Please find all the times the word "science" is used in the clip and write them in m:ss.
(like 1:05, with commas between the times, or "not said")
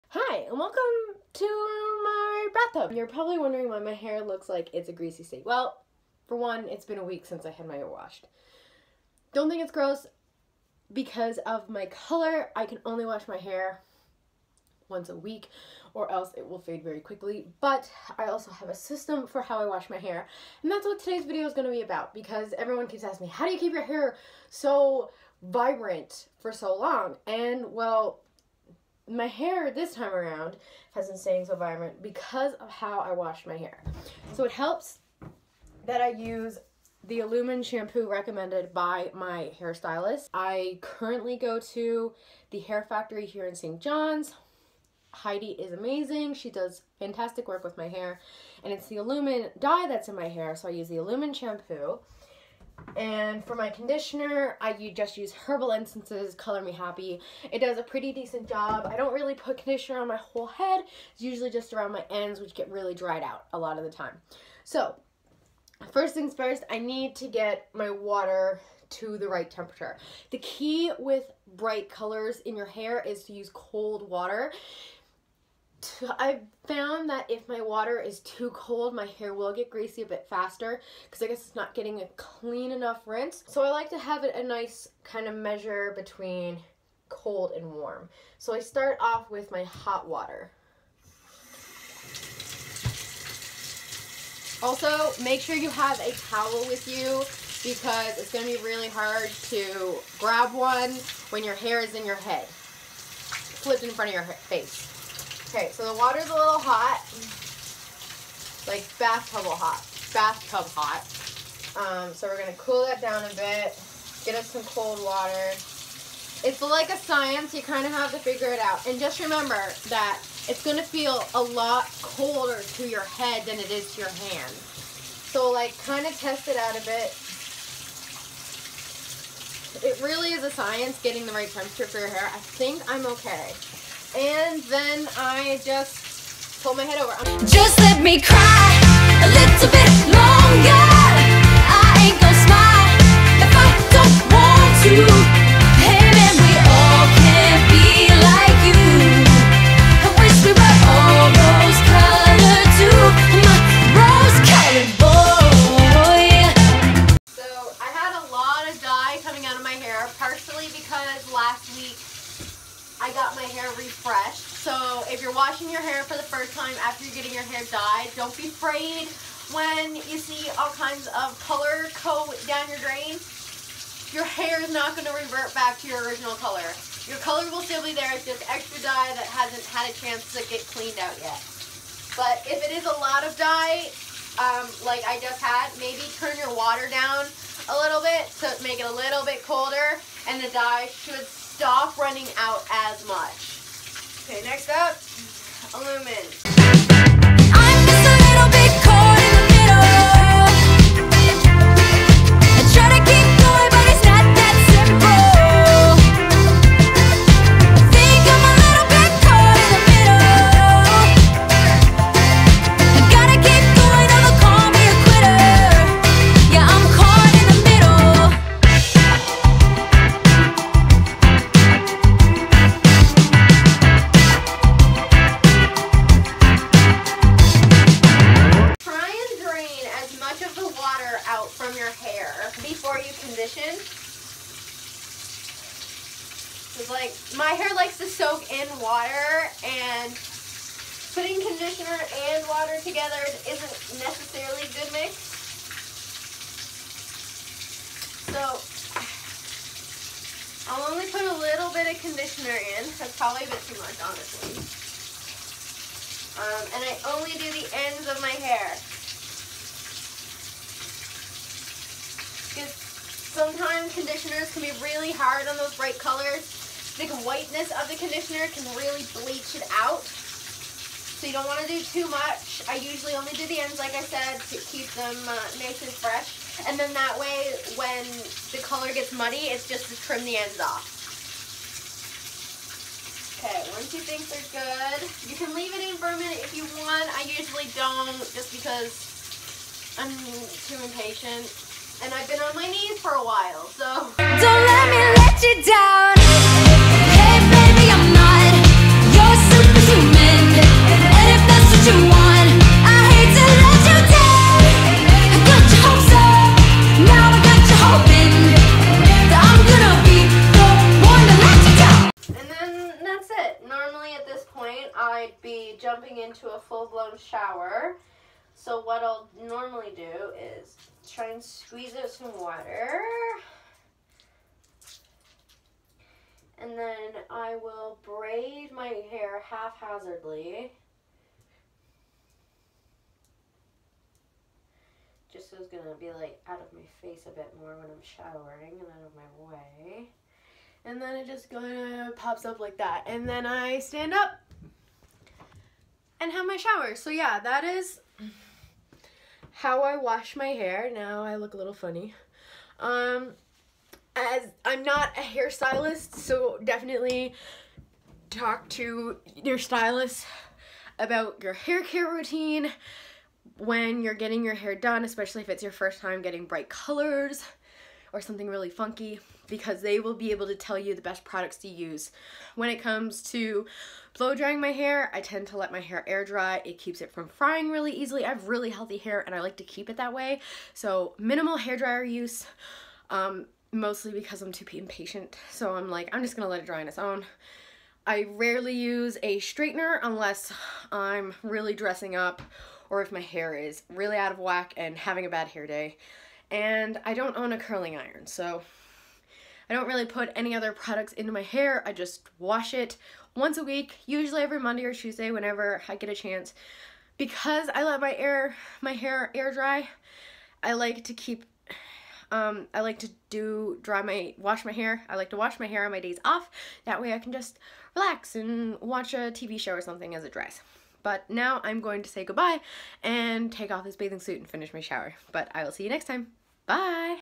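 1:56, 2:10.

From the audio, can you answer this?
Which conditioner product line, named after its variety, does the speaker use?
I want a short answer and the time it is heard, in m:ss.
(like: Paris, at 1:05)
Herbal Essences Color Me Happy, at 0:55.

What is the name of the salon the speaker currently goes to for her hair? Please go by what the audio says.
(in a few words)
Hair Factory.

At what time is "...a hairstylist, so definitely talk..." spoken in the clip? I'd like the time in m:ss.
5:55.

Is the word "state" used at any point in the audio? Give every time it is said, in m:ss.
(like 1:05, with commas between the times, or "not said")
0:05.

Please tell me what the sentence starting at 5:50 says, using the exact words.
Now I look a little funny.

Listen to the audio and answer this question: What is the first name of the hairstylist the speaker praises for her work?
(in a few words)
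Heidi.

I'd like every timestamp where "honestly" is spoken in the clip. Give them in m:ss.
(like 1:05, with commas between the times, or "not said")
4:13.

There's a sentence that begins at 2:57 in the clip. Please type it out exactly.
Your color will still be there, it's just extra dye that hasn't had a chance to get cleaned out yet.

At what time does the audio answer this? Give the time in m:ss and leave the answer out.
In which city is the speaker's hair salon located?
0:43.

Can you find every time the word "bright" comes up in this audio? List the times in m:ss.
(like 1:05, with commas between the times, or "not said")
1:11, 4:25, 6:06.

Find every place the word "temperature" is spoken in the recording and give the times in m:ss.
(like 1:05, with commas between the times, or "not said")
1:09, 2:11.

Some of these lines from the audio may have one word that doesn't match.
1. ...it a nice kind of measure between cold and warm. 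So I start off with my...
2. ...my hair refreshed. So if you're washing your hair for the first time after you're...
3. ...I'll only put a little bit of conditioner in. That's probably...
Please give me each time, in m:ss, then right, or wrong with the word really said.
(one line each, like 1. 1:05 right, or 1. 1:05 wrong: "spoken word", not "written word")
1. 1:24 right
2. 2:43 right
3. 4:10 right.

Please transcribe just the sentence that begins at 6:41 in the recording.
I just wash it once a week, usually every Monday or Tuesday whenever I get a chance.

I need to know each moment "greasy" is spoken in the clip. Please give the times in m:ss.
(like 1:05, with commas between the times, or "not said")
0:04, 1:19.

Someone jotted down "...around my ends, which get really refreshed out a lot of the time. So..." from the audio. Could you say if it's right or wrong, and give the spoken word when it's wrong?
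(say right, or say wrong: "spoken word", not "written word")
wrong: "dried", not "refreshed".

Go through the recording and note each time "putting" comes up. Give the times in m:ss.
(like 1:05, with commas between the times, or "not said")
4:01.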